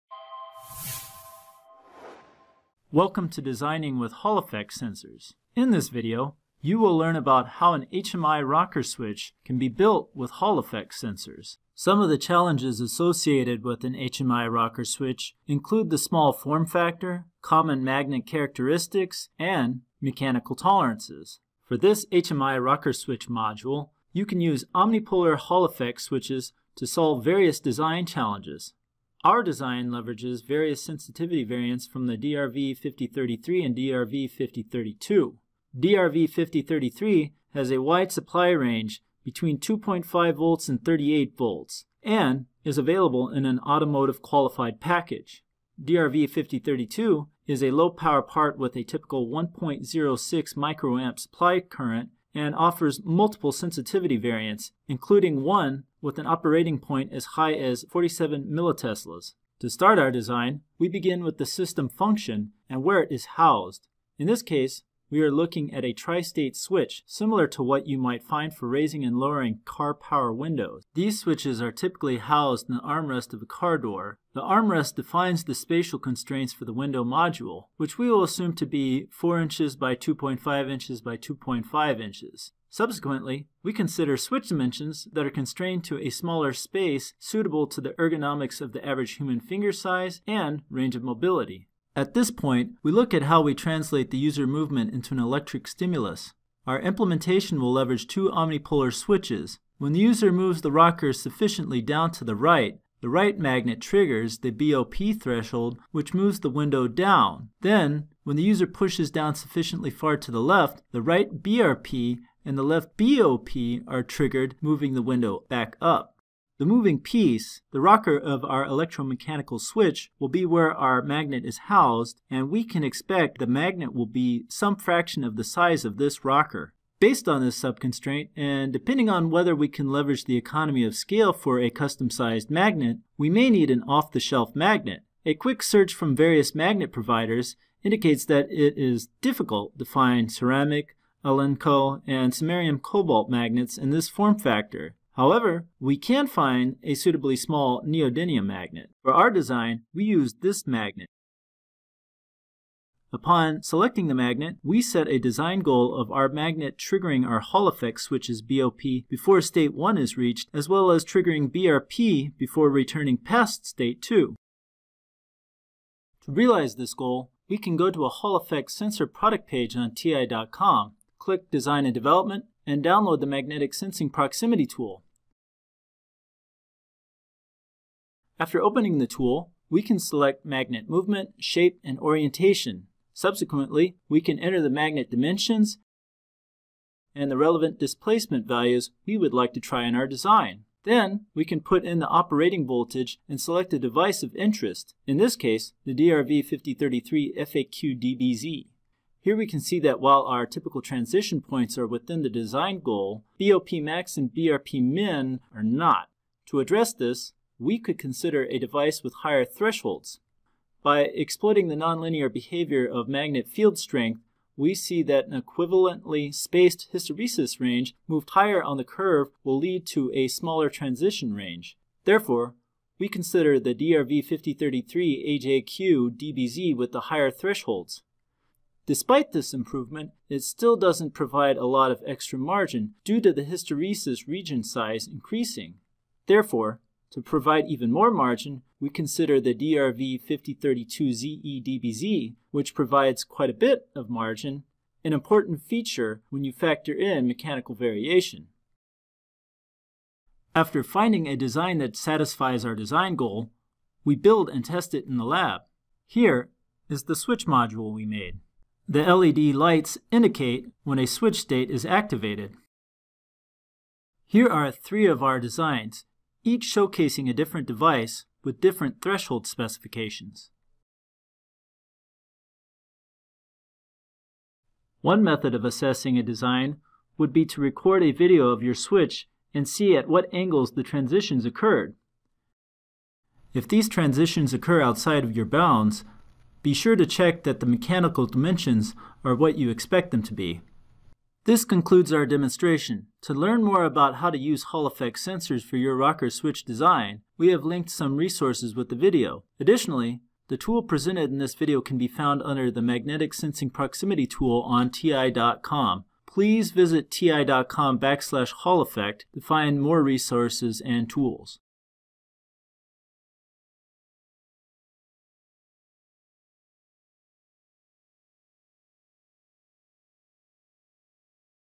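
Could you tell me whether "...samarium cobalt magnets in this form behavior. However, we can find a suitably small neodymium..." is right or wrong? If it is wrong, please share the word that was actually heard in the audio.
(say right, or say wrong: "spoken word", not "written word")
wrong: "factor", not "behavior".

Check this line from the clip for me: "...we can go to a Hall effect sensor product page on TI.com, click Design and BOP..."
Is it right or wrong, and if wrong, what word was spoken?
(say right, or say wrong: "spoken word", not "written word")
wrong: "Development", not "BOP".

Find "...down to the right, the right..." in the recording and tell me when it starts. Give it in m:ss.
1:41.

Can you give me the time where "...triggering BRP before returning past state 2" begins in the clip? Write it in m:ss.
2:41.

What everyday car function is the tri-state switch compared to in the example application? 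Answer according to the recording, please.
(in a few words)
power windows.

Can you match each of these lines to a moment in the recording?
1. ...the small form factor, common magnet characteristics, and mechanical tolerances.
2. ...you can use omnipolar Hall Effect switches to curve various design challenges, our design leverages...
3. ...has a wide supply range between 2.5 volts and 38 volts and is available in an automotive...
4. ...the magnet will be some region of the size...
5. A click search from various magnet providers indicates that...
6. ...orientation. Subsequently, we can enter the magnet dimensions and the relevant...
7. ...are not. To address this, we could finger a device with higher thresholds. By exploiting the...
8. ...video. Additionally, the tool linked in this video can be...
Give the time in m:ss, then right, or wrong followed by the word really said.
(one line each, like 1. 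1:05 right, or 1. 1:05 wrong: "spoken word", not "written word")
1. 0:15 right
2. 0:24 wrong: "solve", not "curve"
3. 0:37 right
4. 2:03 wrong: "fraction", not "region"
5. 2:15 wrong: "quick", not "click"
6. 3:01 right
7. 3:25 wrong: "consider", not "finger"
8. 4:58 wrong: "presented", not "linked".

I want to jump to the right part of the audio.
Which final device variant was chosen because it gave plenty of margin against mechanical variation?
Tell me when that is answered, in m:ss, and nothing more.
3:59.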